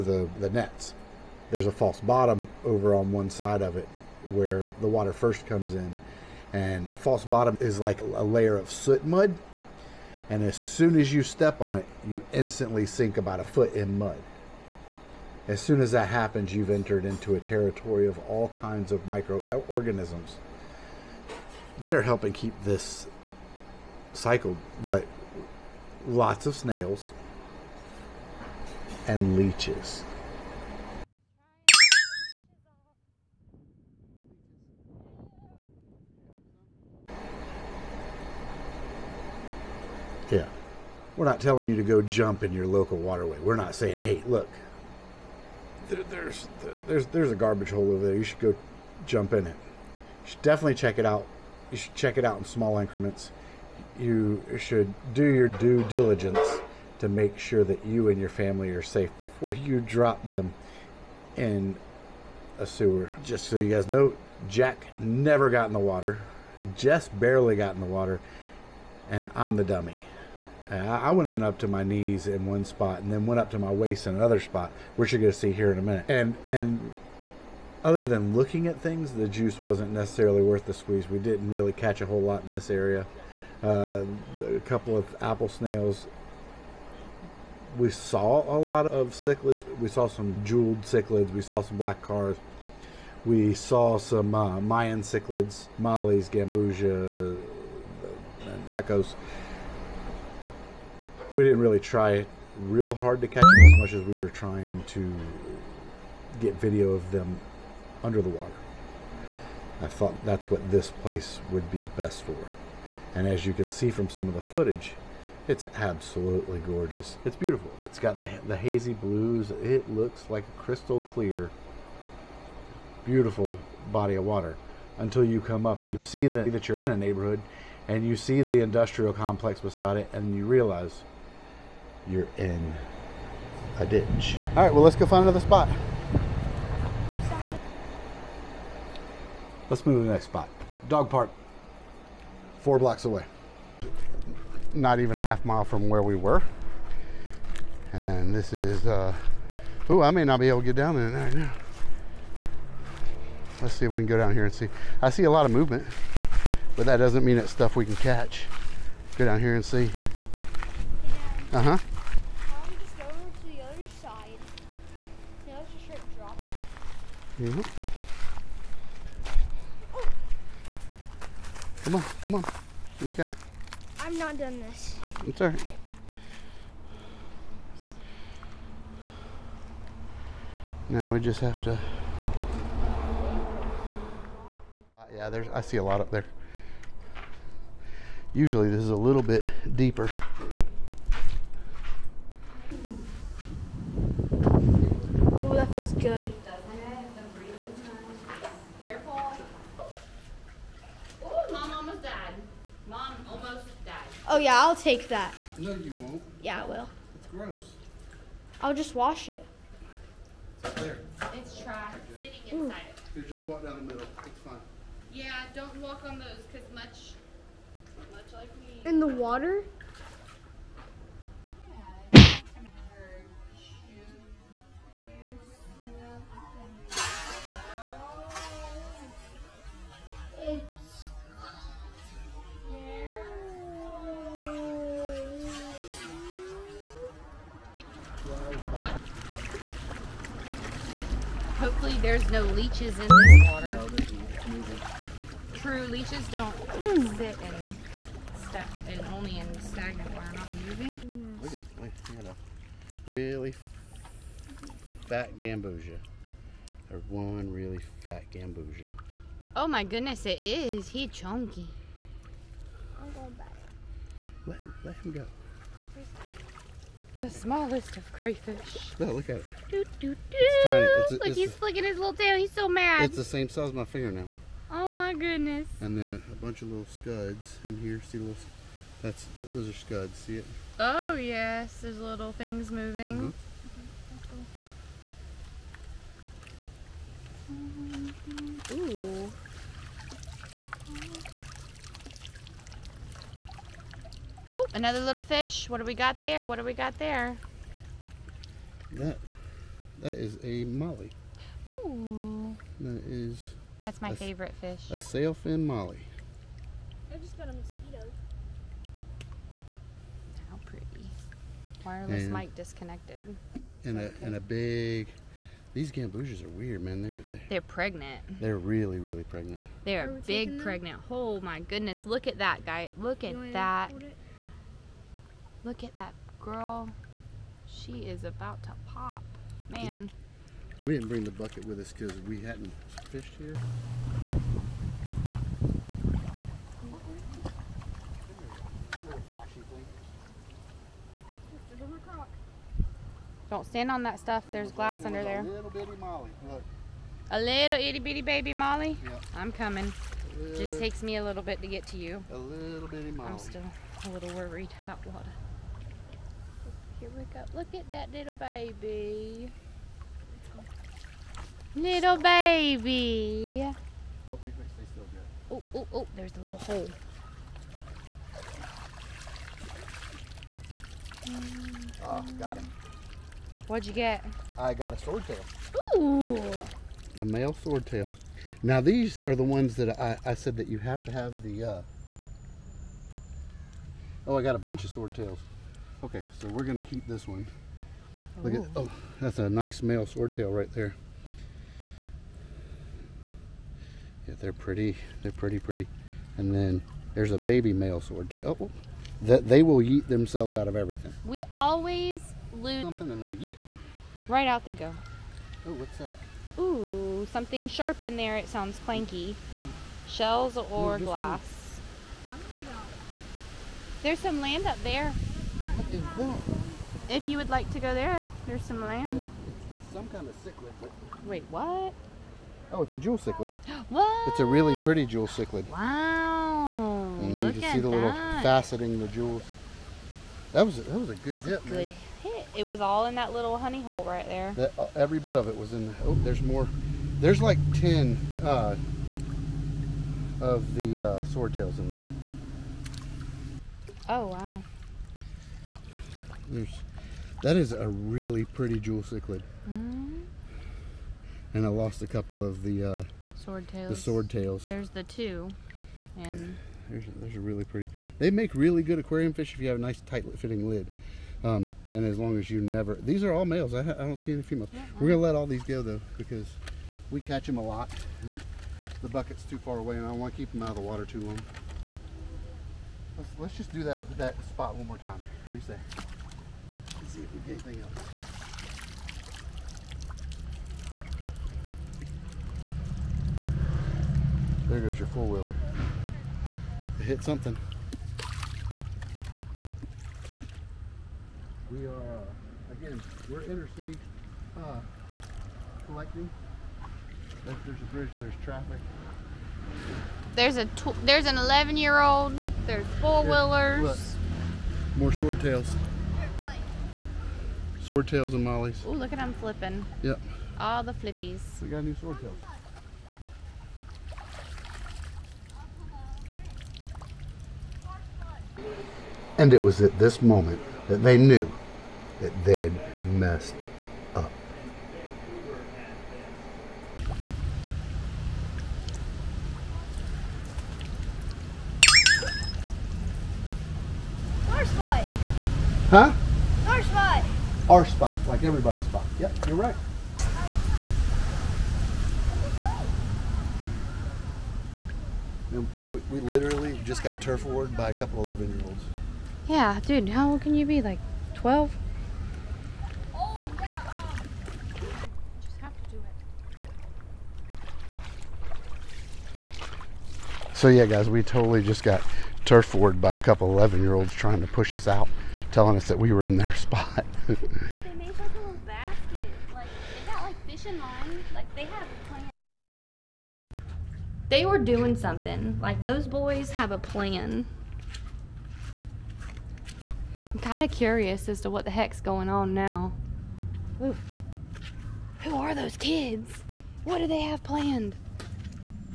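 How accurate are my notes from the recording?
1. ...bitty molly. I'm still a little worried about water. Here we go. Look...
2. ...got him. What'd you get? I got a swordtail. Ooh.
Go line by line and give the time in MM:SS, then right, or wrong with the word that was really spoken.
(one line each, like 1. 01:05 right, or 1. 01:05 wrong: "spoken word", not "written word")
1. 05:52 right
2. 06:12 right.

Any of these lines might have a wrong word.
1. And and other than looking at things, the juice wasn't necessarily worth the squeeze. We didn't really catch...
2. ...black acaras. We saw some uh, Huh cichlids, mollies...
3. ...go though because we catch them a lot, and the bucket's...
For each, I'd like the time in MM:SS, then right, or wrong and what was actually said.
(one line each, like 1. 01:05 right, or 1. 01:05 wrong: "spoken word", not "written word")
1. 01:16 right
2. 01:31 wrong: "Mayan", not "Huh"
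3. 07:45 right.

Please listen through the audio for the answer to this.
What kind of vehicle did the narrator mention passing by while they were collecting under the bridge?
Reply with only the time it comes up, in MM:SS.
08:05.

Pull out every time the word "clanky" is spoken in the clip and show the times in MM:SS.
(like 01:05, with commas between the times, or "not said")
06:48.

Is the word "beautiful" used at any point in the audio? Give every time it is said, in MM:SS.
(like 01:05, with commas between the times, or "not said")
01:57, 02:03.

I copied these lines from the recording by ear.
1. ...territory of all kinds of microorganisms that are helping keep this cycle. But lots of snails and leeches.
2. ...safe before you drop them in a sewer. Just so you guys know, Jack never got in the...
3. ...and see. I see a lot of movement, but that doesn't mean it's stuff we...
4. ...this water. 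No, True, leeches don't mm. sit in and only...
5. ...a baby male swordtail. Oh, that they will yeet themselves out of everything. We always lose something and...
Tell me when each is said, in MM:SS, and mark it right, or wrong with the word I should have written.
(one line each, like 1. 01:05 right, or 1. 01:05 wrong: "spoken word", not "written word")
1. 00:17 right
2. 00:58 right
3. 02:34 right
4. 04:03 right
5. 06:37 right.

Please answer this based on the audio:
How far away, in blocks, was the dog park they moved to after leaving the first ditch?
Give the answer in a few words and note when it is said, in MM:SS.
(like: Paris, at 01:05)
4 blocks, at 02:22.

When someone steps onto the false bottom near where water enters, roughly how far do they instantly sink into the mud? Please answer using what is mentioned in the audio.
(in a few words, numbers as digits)
About a foot.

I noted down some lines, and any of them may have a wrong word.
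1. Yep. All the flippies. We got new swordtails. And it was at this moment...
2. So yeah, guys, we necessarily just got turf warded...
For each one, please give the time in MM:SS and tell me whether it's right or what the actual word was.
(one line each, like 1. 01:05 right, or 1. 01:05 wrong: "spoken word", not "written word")
1. 08:30 right
2. 09:20 wrong: "totally", not "necessarily".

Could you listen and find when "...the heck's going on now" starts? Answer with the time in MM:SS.
09:41.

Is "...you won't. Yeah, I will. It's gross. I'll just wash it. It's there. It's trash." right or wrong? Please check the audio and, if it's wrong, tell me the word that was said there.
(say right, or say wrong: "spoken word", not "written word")
right.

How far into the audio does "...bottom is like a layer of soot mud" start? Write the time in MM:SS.
00:07.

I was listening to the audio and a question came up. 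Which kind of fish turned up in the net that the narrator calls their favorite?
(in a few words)
Sailfin molly.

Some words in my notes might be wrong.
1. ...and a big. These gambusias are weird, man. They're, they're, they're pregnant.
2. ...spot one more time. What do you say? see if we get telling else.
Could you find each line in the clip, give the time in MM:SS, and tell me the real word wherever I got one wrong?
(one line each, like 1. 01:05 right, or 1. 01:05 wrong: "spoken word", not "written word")
1. 05:14 right
2. 07:54 wrong: "anything", not "telling".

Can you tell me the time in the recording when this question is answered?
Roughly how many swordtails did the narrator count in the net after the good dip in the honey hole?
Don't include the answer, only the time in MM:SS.
07:17.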